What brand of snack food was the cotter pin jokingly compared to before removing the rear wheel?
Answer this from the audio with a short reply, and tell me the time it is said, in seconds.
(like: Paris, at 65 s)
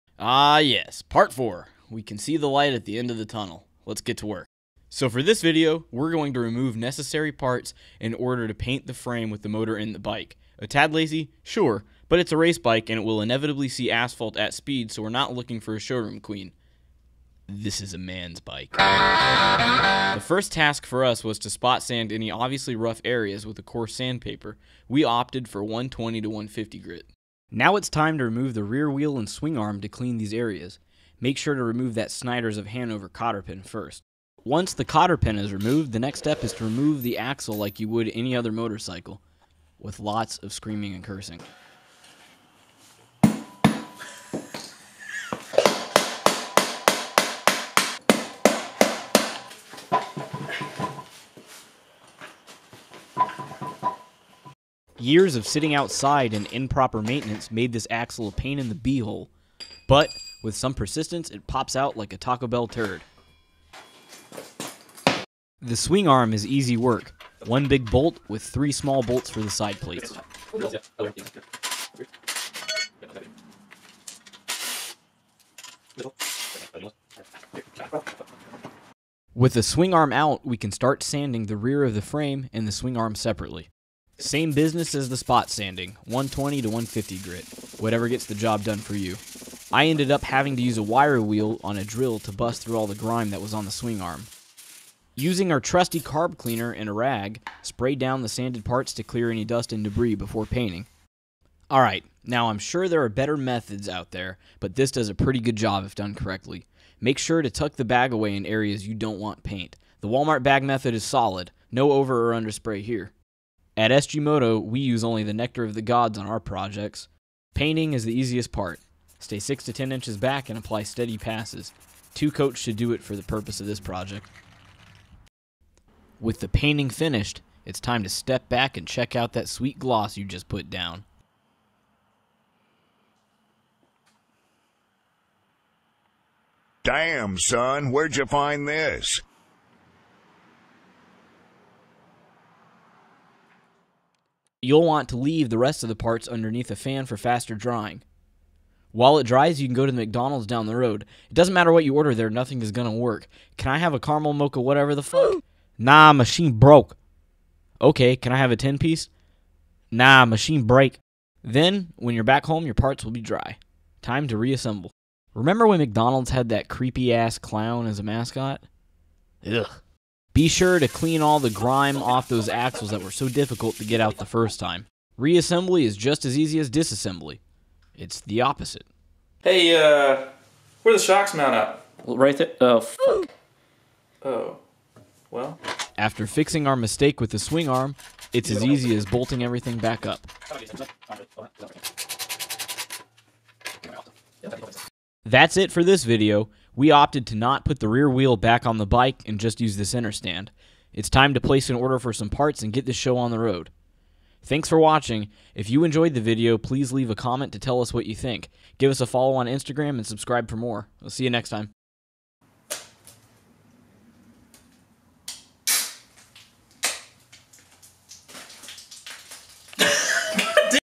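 Snyder's of Hanover, at 32 s.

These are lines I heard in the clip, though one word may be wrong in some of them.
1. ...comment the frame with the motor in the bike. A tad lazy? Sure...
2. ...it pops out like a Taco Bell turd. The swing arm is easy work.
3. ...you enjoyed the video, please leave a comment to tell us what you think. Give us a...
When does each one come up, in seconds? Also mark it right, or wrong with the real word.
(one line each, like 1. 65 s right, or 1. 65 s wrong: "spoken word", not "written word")
1. 8 s wrong: "paint", not "comment"
2. 61 s right
3. 205 s right.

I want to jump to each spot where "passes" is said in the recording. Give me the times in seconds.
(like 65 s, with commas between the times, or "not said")
121 s.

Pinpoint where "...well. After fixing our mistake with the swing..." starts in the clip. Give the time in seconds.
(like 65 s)
185 s.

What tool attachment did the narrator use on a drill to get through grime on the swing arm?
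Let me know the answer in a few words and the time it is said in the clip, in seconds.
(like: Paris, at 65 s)
Wire wheel, at 90 s.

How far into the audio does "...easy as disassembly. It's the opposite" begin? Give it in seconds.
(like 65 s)
176 s.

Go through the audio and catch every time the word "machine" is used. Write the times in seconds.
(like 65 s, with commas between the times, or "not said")
156 s, 160 s.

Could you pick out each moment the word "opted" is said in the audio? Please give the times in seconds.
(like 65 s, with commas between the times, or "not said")
25 s, 196 s.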